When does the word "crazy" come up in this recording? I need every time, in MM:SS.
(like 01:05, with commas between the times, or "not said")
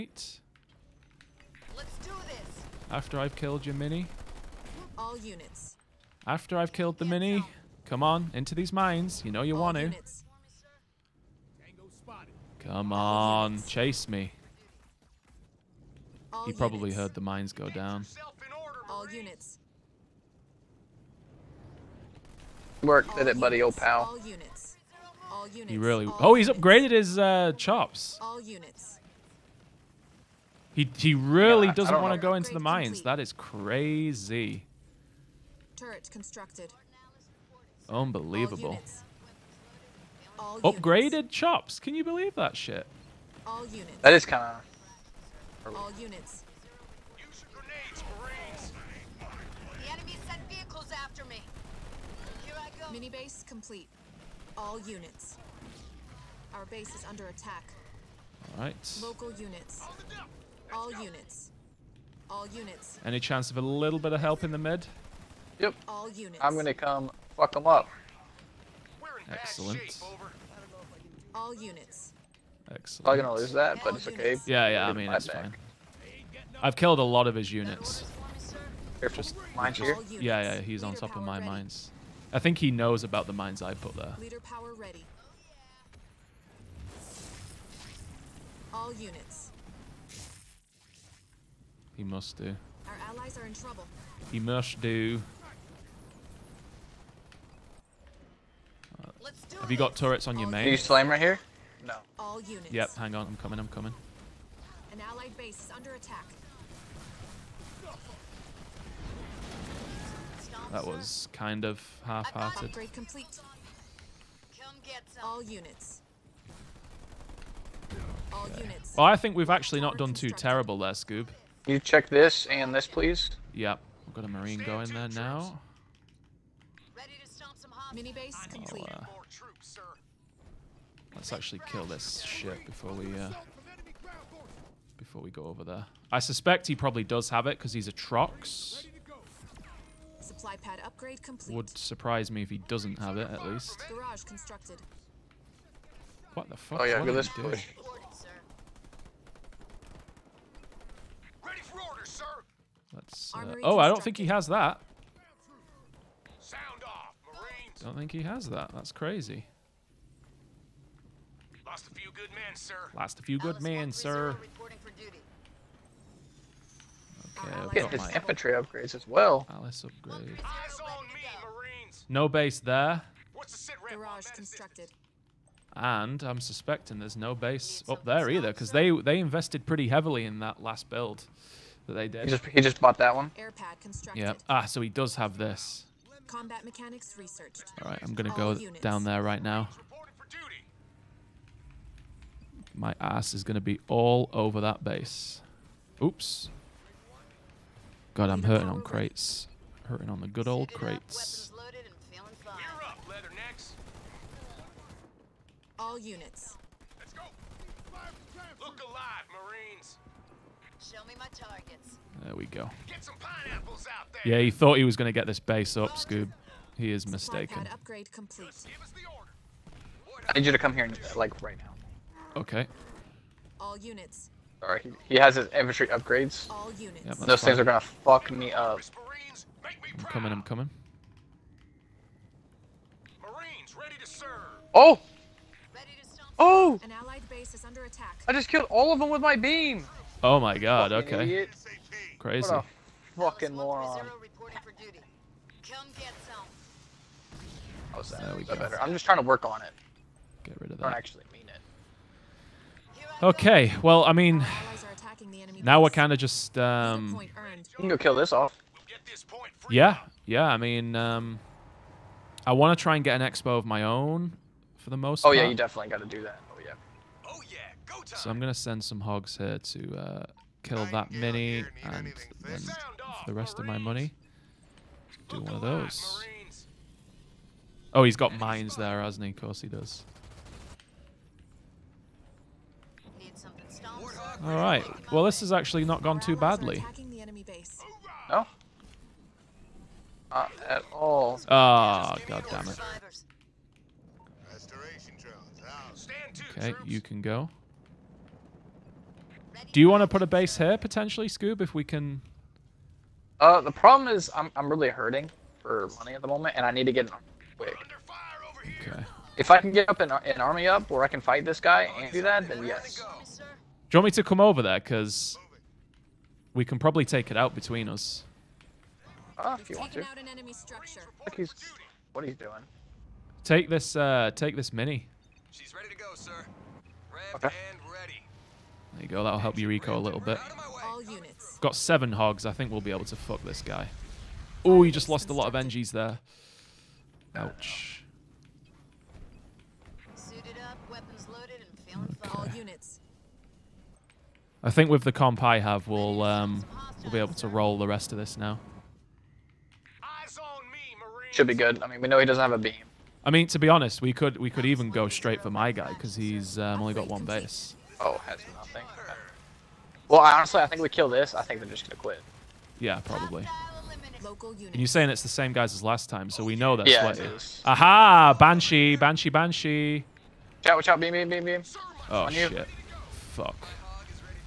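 00:33, 02:38, 04:02.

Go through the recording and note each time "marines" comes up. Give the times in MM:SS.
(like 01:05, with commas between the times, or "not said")
02:04, 03:29, 03:53.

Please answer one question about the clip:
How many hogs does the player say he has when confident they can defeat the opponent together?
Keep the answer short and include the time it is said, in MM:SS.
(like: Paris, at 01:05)
7, at 05:31.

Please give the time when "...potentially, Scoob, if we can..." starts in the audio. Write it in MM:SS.
05:00.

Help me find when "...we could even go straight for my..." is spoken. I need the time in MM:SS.
05:54.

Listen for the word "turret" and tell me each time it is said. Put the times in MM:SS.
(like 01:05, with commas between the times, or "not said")
00:35, 01:39.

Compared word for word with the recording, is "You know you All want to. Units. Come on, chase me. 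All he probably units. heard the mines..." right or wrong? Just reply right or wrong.
right.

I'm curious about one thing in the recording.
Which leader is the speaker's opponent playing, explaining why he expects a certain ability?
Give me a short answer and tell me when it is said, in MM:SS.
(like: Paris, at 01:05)
Atriox, at 02:17.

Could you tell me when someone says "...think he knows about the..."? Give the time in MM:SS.
01:22.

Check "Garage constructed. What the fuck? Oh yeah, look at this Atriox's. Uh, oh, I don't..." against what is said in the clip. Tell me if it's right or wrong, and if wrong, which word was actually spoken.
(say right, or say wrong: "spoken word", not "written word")
wrong: "Let", not "Atriox".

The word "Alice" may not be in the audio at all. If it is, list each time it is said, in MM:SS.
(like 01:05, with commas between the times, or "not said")
02:49.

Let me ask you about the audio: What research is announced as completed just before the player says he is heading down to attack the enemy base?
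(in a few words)
Combat mechanics.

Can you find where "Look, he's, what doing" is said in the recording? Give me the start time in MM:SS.
05:19.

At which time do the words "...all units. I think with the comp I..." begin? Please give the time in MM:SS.
05:42.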